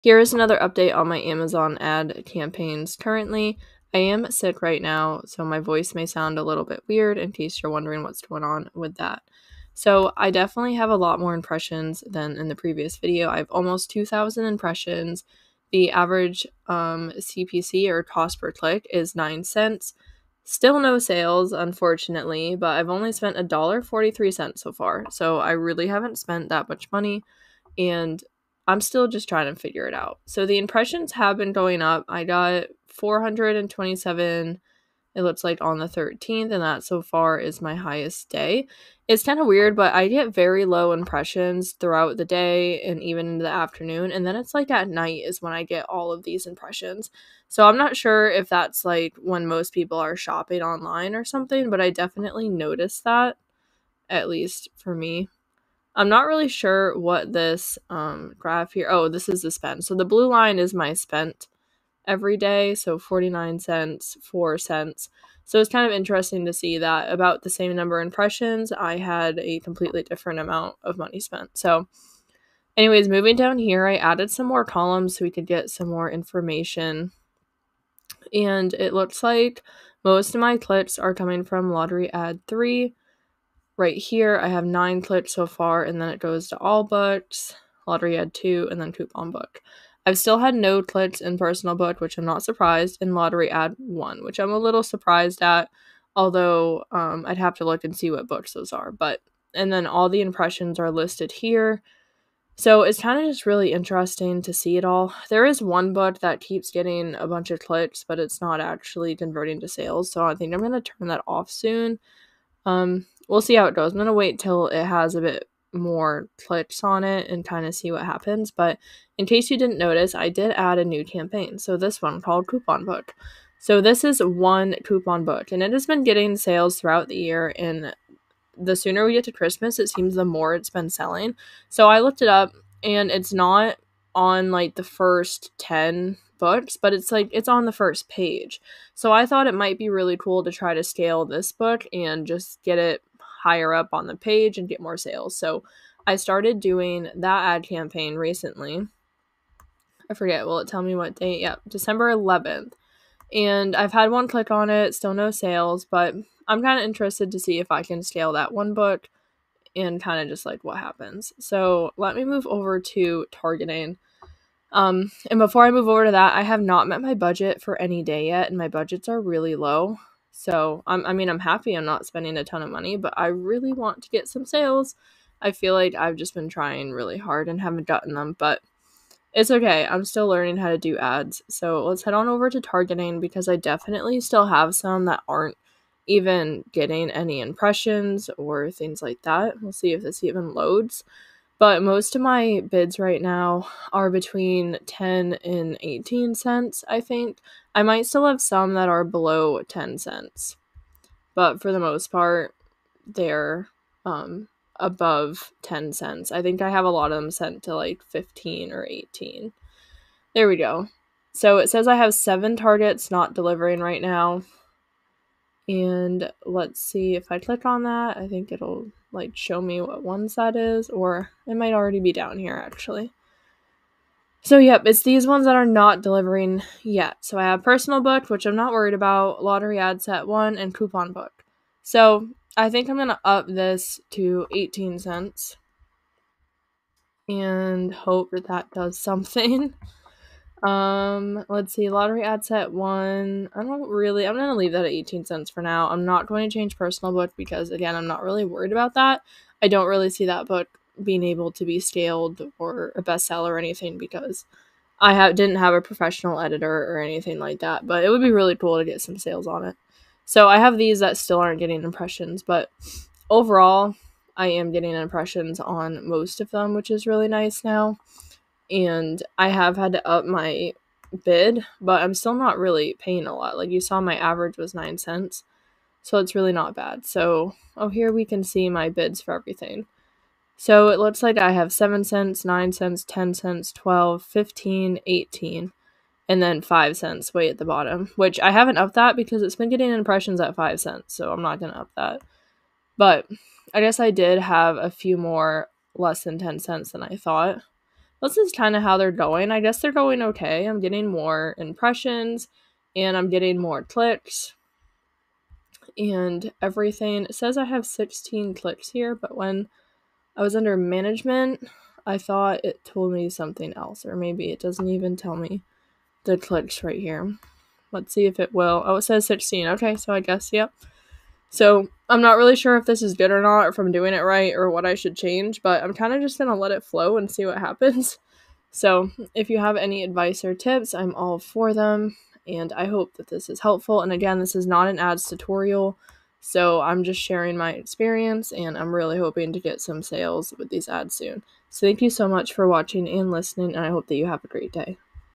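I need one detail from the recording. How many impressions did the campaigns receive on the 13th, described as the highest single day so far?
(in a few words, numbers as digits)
427.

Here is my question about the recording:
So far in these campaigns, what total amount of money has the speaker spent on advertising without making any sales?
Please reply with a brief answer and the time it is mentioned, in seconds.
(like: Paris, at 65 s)
$1.43, at 23 s.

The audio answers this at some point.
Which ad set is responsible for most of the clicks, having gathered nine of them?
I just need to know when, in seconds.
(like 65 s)
81 s.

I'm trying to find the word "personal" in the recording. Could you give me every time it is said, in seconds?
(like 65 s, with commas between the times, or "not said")
91 s, 227 s, 246 s.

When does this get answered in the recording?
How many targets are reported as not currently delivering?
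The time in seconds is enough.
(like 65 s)
212 s.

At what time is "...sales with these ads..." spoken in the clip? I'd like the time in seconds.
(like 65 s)
340 s.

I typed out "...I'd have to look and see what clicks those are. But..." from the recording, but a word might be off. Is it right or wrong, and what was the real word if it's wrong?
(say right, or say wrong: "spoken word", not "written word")
wrong: "books", not "clicks".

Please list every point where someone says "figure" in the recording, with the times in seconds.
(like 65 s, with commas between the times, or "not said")
29 s.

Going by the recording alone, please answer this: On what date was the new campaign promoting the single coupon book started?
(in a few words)
December 11th.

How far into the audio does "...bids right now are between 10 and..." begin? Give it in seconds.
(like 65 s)
192 s.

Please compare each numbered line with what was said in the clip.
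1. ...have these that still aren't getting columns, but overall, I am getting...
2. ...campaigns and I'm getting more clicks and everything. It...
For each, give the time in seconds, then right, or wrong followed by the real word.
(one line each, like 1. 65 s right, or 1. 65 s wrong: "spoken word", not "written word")
1. 260 s wrong: "impressions", not "columns"
2. 301 s wrong: "impressions", not "campaigns".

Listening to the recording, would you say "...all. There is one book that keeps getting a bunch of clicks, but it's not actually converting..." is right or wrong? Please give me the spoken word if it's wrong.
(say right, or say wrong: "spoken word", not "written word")
right.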